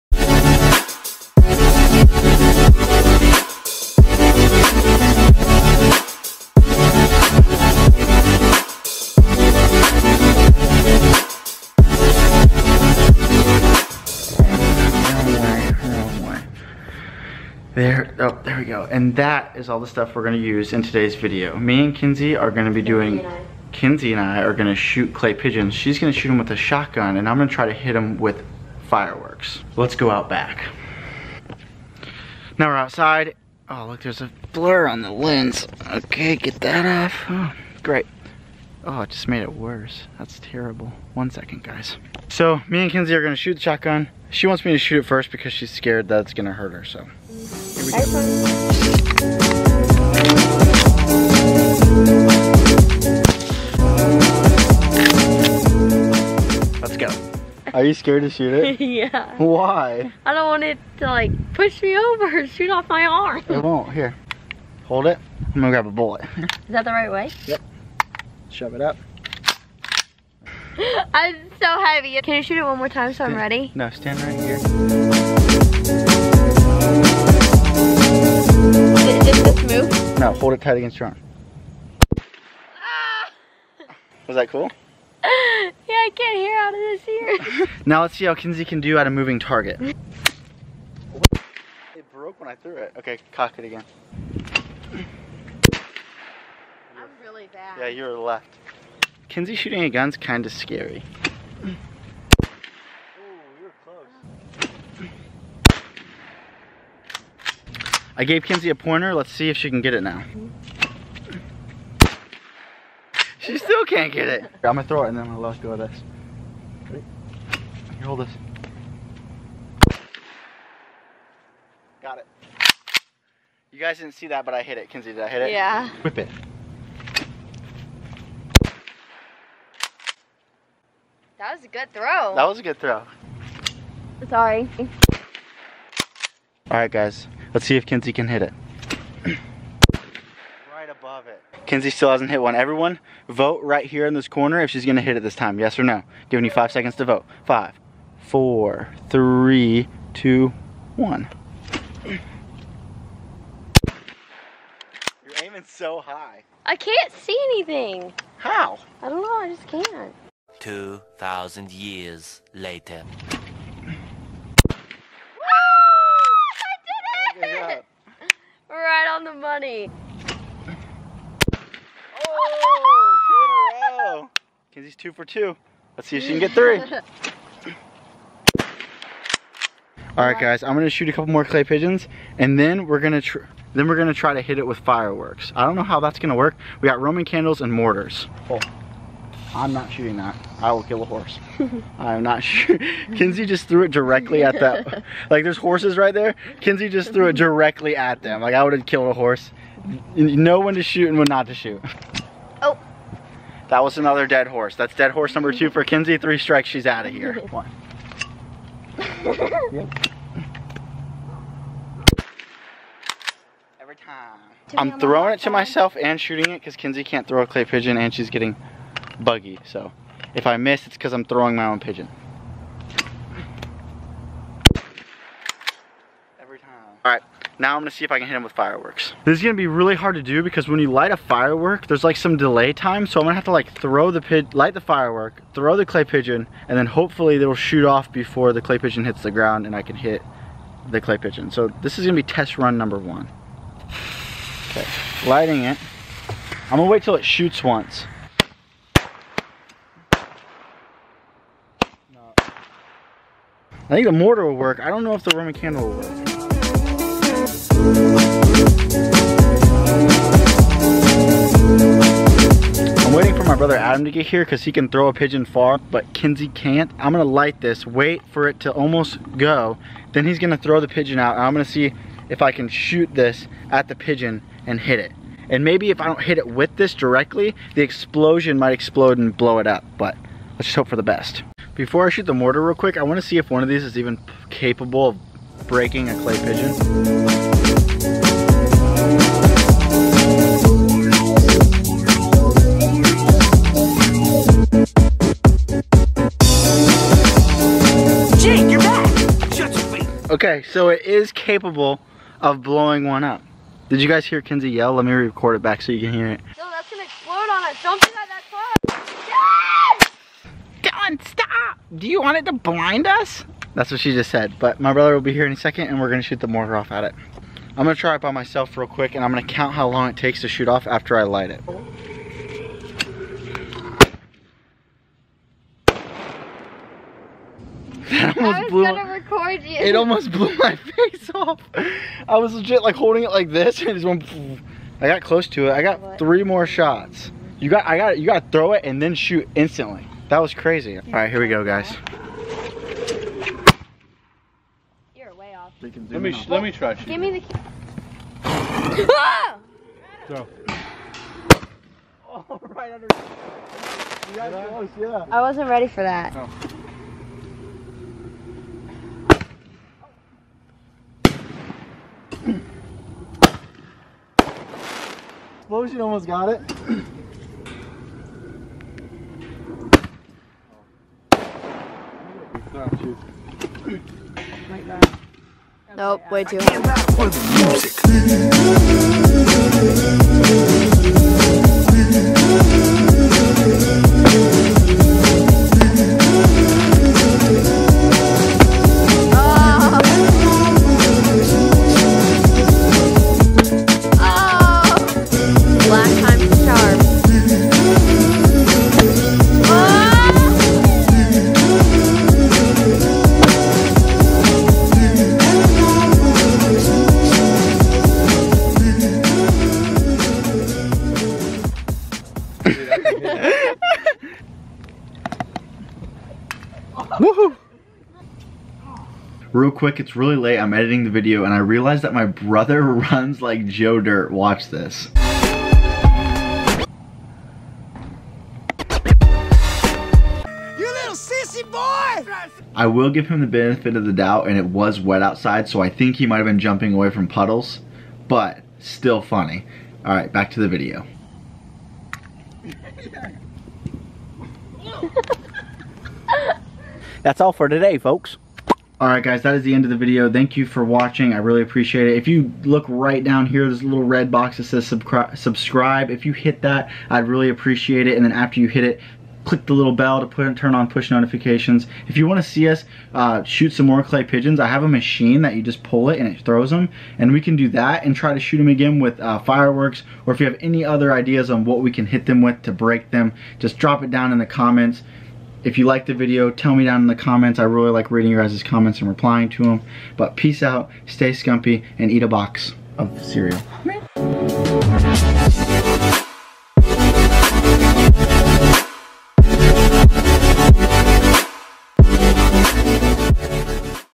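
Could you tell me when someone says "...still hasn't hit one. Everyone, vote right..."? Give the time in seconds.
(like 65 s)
141 s.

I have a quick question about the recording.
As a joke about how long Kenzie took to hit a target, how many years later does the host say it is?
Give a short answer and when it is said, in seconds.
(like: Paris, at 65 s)
2,000, at 160 s.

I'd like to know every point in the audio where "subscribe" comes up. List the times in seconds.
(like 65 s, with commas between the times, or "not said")
454 s.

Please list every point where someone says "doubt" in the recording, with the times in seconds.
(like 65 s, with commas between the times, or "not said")
434 s.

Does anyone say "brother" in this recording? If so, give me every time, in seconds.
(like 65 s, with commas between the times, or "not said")
263 s, 314 s, 422 s.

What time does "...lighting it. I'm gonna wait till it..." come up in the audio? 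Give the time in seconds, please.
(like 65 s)
245 s.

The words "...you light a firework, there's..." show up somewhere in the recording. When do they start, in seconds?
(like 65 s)
230 s.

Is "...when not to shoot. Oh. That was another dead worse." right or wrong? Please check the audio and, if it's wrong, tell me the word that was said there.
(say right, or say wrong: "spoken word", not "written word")
wrong: "horse", not "worse".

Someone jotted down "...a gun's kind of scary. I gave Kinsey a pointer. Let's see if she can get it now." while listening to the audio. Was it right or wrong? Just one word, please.
wrong.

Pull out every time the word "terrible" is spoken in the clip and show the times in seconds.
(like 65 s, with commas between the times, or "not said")
40 s.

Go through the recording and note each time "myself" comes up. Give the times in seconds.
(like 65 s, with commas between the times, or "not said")
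215 s, 318 s.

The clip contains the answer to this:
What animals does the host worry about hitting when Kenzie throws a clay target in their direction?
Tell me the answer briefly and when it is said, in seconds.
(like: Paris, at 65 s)
Horses, at 195 s.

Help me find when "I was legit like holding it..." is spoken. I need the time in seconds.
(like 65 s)
332 s.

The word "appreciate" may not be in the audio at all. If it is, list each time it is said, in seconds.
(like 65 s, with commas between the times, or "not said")
451 s, 457 s.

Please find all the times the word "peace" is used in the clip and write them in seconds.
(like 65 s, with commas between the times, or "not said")
480 s.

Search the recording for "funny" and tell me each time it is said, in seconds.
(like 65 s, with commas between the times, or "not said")
169 s, 439 s.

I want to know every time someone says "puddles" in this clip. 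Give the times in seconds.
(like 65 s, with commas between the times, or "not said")
437 s.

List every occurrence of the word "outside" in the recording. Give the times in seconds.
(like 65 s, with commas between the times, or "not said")
32 s, 435 s.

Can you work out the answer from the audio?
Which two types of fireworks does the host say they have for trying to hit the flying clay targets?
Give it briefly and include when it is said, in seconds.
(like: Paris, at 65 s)
Roman candles and mortars, at 187 s.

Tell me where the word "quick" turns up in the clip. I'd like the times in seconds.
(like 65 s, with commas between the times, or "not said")
282 s, 318 s, 419 s.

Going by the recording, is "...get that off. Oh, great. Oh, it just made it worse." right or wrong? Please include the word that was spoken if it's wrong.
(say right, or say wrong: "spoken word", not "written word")
right.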